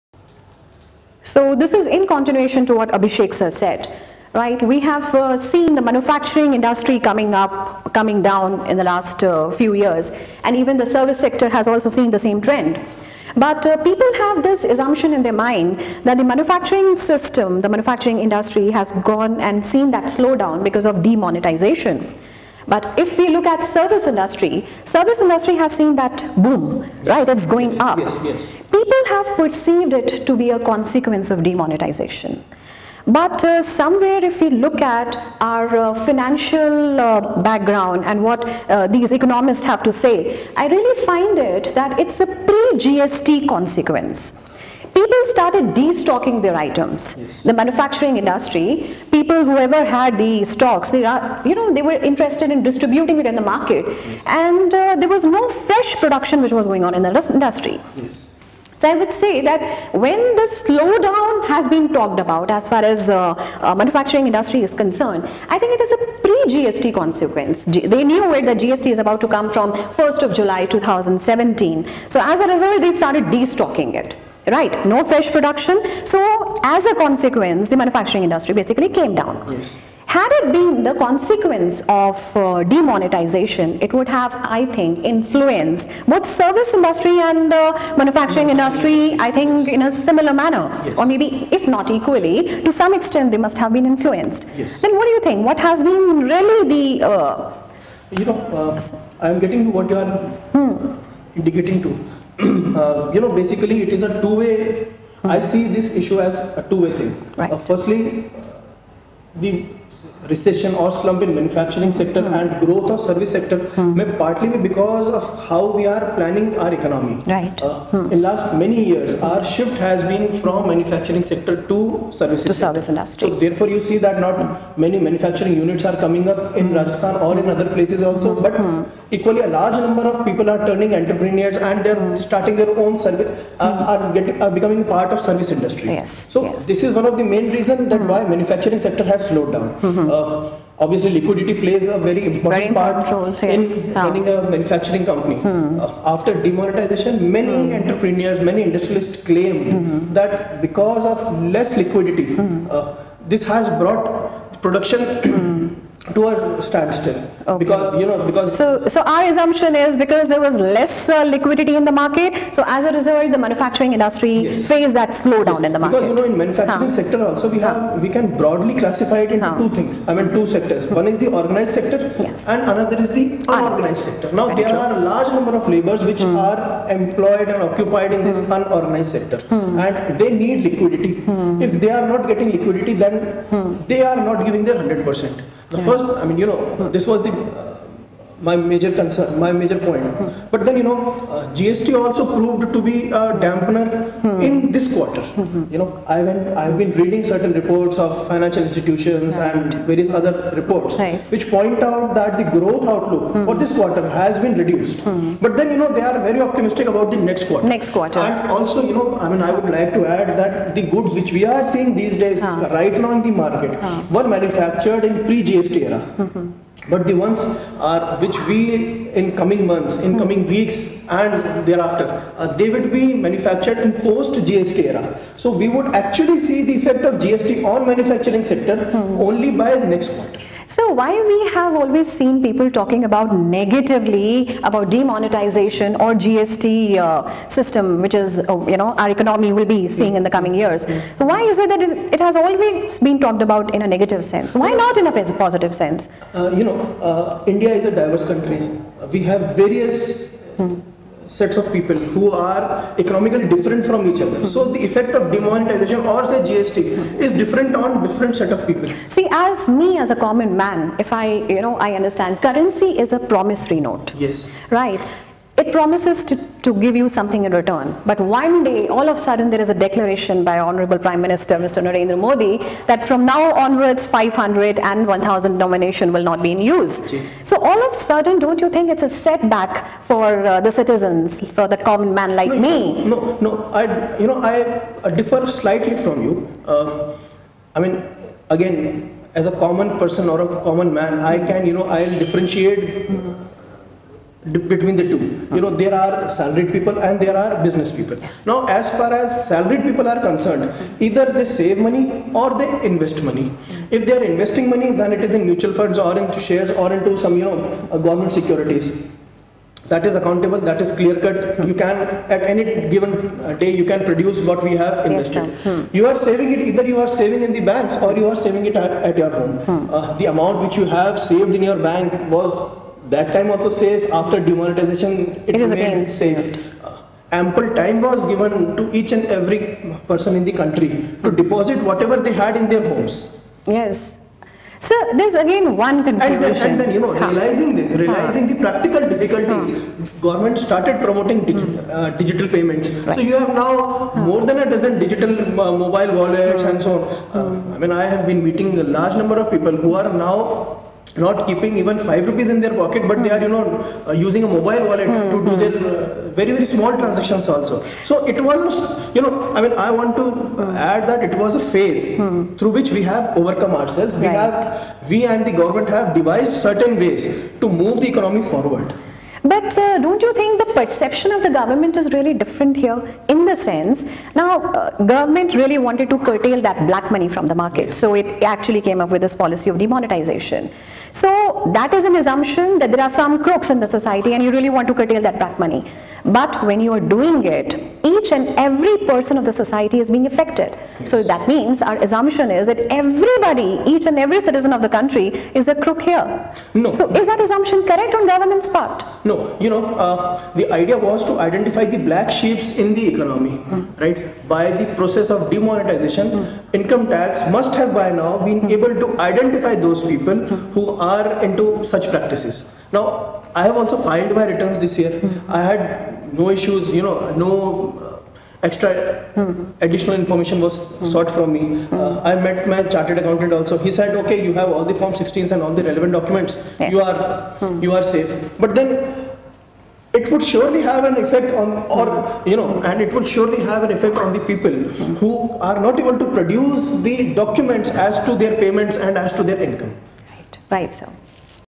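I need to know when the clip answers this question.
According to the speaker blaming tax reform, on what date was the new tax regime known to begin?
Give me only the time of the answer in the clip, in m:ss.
1:09.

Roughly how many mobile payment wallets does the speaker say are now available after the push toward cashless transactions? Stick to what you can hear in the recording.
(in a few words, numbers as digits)
More than a dozen.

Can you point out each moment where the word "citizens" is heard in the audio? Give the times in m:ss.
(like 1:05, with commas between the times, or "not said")
4:40, 6:34.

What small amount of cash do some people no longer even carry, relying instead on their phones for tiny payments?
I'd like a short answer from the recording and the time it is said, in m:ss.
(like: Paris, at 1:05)
5 rupees, at 5:51.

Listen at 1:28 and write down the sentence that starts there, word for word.
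industry, I think, in a similar manner.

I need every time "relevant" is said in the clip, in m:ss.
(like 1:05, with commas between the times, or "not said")
7:05.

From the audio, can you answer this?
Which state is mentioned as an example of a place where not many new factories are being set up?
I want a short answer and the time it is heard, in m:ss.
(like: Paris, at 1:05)
Rajasthan, at 2:06.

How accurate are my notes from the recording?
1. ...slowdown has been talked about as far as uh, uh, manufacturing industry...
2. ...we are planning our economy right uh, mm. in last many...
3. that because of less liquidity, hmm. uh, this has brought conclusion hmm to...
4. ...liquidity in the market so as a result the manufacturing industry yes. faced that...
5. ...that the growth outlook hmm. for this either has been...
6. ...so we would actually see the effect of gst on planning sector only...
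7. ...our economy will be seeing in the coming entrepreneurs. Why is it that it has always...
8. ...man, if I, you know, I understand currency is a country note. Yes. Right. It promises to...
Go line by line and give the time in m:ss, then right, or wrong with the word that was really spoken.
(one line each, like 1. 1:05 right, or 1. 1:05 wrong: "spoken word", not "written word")
1. 1:00 right
2. 1:55 right
3. 2:30 wrong: "production", not "conclusion"
4. 2:41 right
5. 3:22 wrong: "quarter", not "either"
6. 3:45 wrong: "manufacturing", not "planning"
7. 3:58 wrong: "years", not "entrepreneurs"
8. 4:20 wrong: "promissory", not "country".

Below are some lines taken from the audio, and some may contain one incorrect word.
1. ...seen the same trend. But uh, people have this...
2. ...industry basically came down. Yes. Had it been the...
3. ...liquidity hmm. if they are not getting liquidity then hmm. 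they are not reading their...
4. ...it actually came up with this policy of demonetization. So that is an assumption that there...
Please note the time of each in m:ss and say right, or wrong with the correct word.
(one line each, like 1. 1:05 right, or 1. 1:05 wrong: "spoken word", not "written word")
1. 0:11 right
2. 1:18 right
3. 3:00 wrong: "giving", not "reading"
4. 6:18 right.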